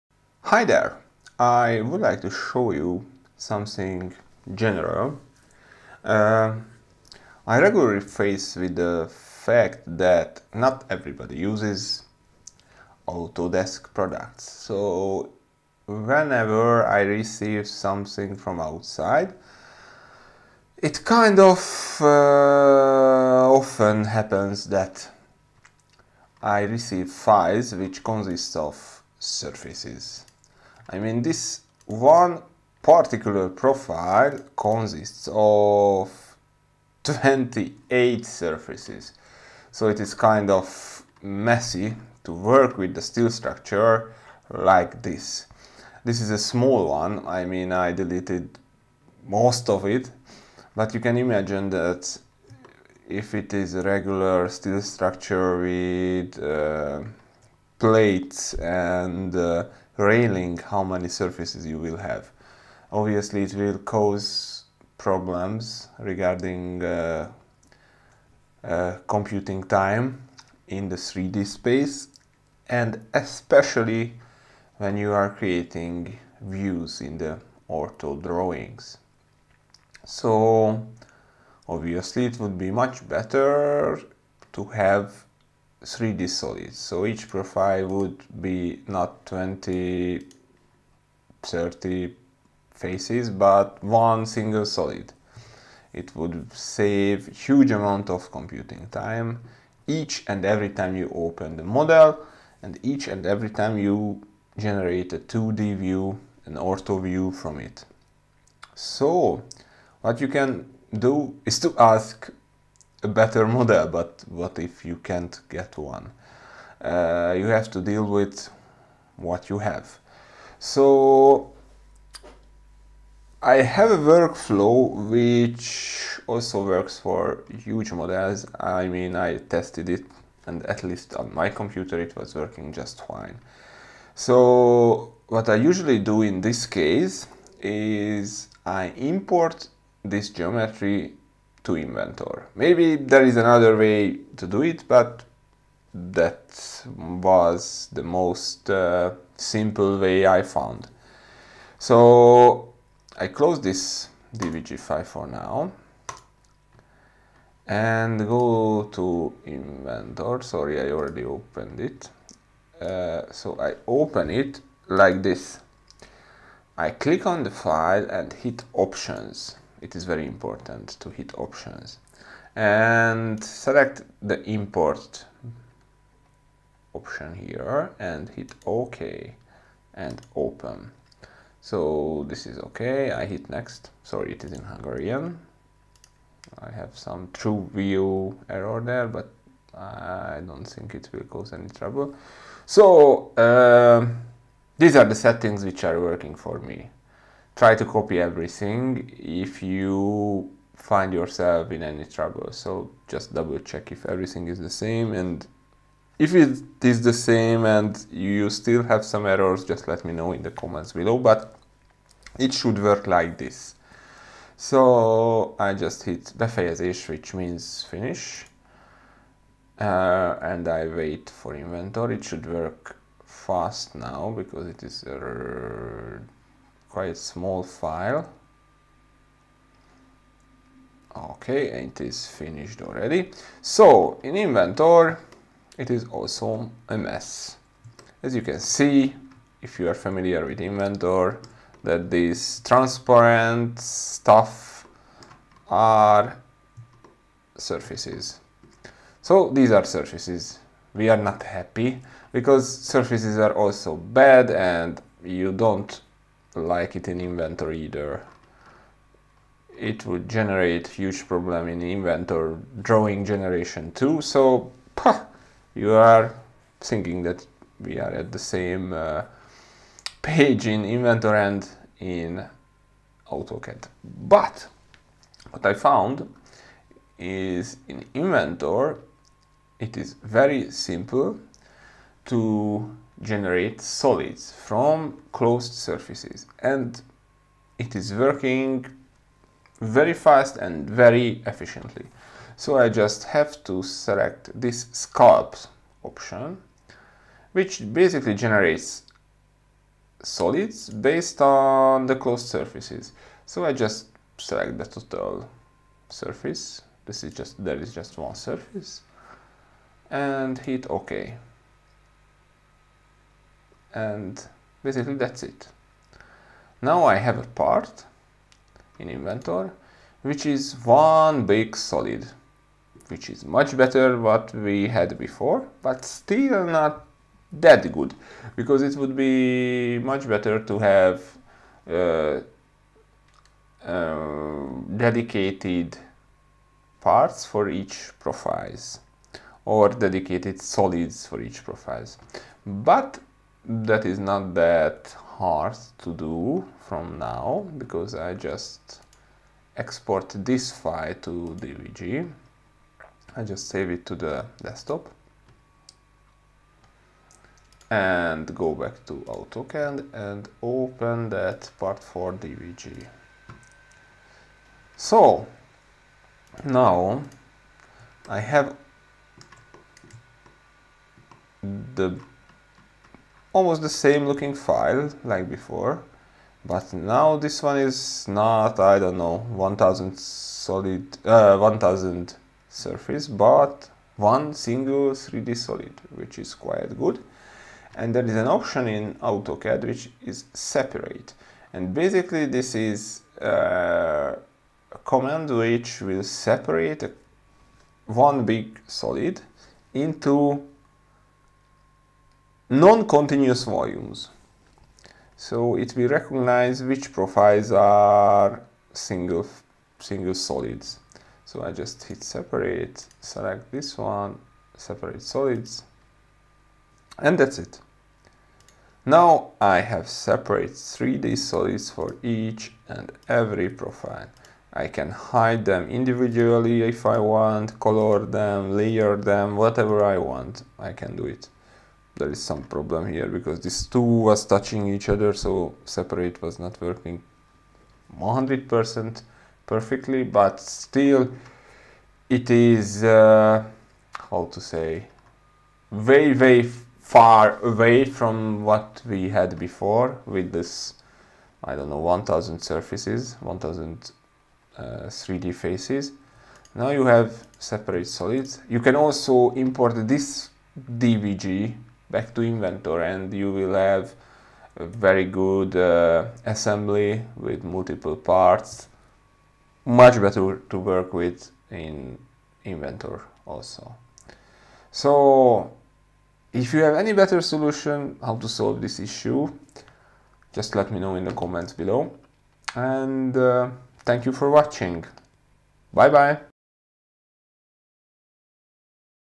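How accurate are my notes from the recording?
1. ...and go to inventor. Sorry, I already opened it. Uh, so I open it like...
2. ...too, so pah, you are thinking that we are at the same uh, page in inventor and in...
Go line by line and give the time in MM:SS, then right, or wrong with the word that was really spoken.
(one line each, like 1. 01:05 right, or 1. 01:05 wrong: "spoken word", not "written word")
1. 02:37 right
2. 04:23 right.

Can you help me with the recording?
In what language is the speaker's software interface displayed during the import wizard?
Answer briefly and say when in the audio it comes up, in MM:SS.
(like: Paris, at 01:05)
Hungarian, at 03:04.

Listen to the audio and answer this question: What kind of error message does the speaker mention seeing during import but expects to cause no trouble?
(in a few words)
TrueView error.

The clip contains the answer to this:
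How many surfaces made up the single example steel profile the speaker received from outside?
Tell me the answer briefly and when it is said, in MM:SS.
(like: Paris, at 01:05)
28, at 00:37.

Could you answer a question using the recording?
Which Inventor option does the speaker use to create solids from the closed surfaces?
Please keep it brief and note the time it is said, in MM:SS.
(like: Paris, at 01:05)
sculpt, at 04:54.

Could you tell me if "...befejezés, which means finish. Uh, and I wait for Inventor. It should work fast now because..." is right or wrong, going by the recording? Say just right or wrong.
right.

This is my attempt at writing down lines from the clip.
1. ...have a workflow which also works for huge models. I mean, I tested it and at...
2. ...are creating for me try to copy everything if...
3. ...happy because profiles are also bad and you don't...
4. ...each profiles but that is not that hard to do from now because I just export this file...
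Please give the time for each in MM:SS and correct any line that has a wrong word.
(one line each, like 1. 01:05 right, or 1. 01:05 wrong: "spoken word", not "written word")
1. 02:03 right
2. 03:15 wrong: "working", not "creating"
3. 04:11 wrong: "surfaces", not "profiles"
4. 05:41 right.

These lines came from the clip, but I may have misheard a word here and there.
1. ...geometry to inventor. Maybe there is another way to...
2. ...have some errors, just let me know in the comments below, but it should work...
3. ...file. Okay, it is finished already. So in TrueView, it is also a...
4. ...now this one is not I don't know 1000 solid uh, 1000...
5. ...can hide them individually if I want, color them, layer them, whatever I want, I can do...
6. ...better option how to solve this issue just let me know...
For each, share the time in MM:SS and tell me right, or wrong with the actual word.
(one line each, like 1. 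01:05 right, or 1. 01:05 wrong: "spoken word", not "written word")
1. 02:20 right
2. 03:28 right
3. 03:47 wrong: "Inventor", not "TrueView"
4. 06:16 right
5. 07:04 right
6. 07:57 wrong: "solution", not "option".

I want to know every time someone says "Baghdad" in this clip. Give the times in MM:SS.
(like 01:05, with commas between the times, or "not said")
not said.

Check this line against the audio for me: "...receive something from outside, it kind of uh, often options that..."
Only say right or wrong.
wrong.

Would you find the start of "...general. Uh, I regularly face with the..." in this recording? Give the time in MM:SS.
00:04.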